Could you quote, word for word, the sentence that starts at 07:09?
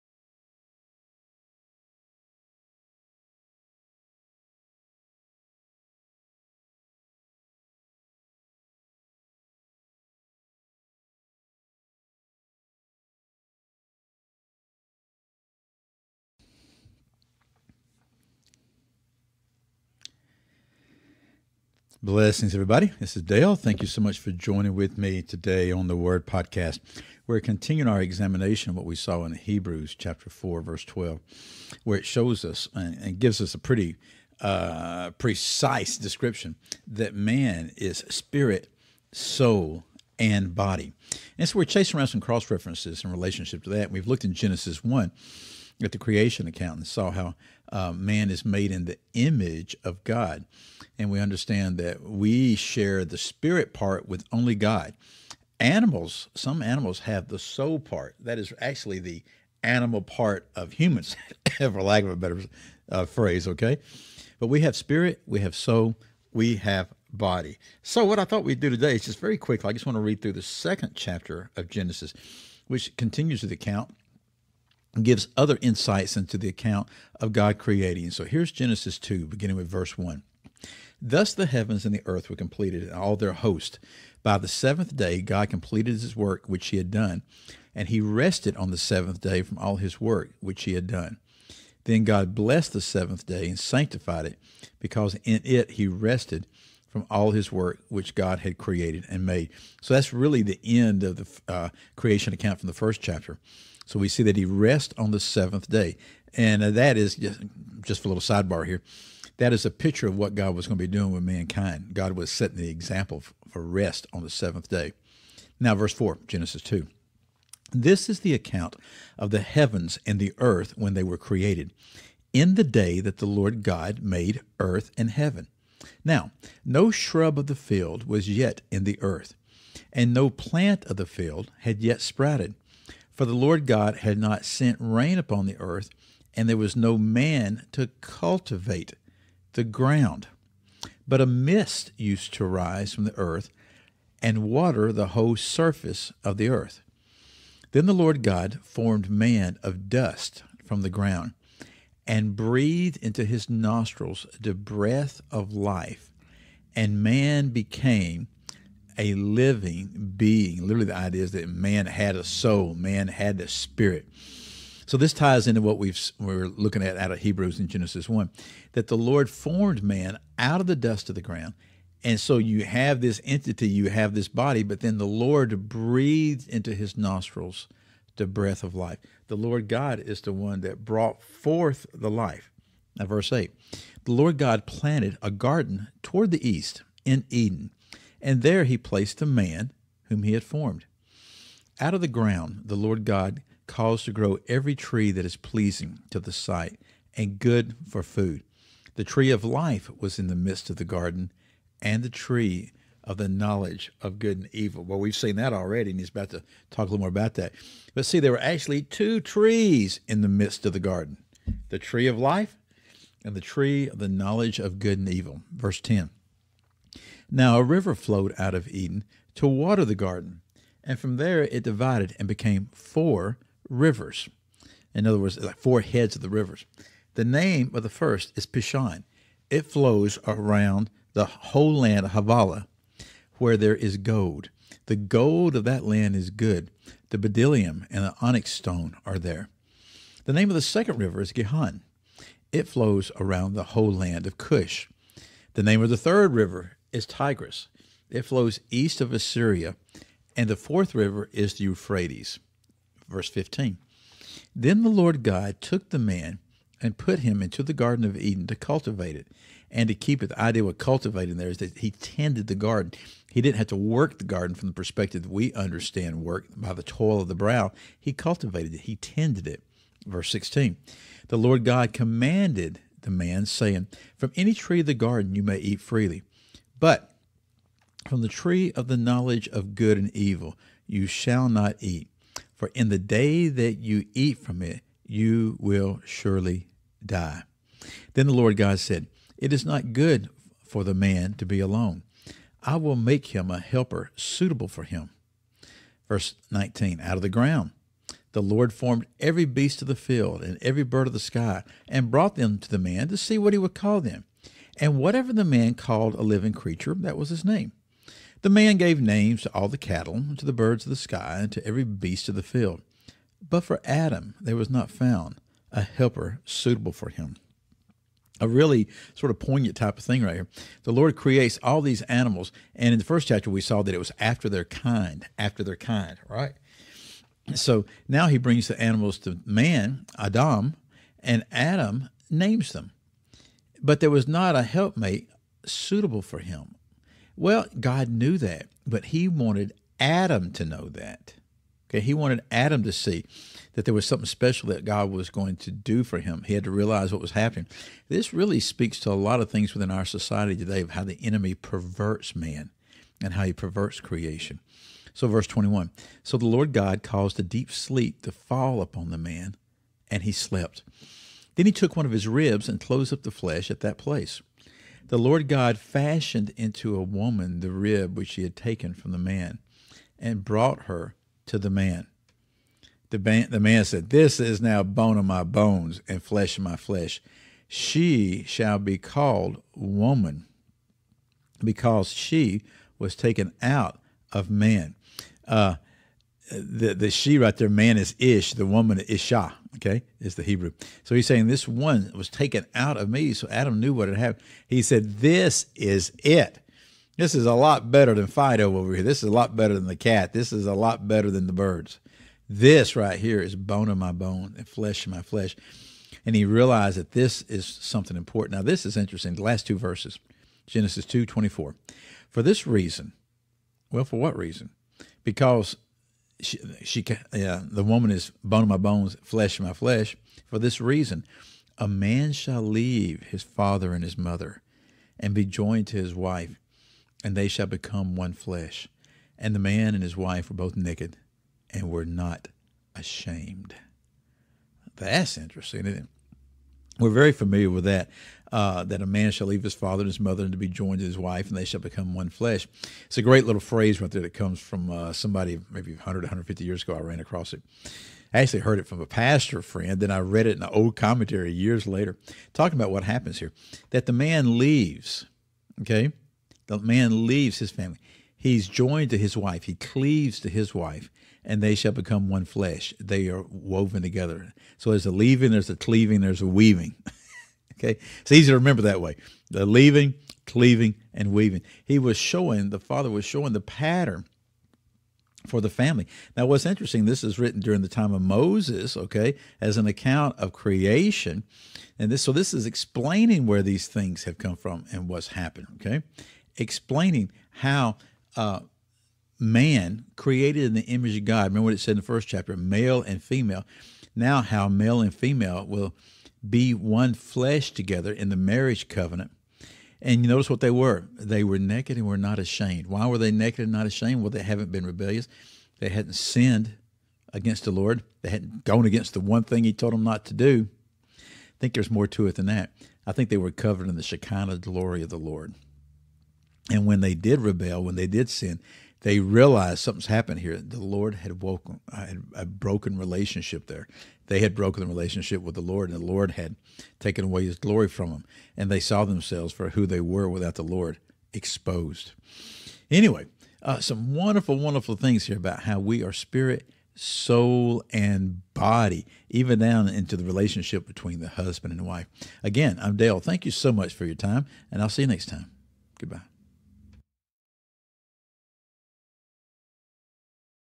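And the man and his wife were both naked and were not ashamed.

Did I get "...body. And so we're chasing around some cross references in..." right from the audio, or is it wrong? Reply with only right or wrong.
right.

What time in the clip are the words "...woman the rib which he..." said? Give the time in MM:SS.
06:07.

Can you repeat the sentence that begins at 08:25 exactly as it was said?
They hadn't sinned against the Lord.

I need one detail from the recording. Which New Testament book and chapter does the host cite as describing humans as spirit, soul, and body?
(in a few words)
Hebrews 4.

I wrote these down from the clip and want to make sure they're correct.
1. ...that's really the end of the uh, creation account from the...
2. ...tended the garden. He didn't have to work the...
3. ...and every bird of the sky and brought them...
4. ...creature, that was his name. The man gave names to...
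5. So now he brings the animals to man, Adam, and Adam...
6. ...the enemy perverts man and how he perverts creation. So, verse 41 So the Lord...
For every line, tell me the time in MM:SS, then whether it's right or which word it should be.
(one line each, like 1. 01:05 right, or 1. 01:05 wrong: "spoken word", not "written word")
1. 01:39 right
2. 04:21 right
3. 05:00 right
4. 05:06 right
5. 05:27 right
6. 05:51 wrong: "21", not "41".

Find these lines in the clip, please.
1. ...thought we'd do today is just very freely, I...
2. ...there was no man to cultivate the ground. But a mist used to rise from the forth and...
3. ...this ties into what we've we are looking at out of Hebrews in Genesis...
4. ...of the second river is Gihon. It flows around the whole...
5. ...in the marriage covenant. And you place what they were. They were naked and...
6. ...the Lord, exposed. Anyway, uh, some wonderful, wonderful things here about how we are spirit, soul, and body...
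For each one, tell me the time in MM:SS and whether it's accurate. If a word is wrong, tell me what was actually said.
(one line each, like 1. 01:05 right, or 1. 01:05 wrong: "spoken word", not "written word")
1. 01:08 wrong: "quickly", not "freely"
2. 02:16 wrong: "earth", not "forth"
3. 02:44 right
4. 04:00 right
5. 08:18 wrong: "notice", not "place"
6. 08:50 right.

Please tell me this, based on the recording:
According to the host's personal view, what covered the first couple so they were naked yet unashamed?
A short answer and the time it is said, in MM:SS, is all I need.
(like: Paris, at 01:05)
The Shekinah glory, at 08:34.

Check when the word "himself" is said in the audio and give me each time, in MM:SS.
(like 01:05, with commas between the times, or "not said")
not said.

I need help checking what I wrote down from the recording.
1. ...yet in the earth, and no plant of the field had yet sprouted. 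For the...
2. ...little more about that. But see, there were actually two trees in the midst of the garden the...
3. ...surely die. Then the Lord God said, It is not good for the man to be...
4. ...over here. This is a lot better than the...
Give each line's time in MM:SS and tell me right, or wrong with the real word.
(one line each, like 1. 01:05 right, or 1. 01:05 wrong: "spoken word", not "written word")
1. 02:08 right
2. 03:26 right
3. 04:46 right
4. 06:38 right.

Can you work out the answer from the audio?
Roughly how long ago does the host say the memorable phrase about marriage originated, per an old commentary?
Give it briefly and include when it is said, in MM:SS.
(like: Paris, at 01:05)
100 to 150 years, at 07:25.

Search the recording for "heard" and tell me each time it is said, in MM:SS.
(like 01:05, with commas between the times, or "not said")
07:28.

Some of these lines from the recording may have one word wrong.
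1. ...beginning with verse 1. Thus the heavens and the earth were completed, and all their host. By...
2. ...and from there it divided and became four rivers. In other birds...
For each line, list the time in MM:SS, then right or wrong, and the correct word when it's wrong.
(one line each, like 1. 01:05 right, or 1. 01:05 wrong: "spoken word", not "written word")
1. 01:19 right
2. 03:40 wrong: "words", not "birds".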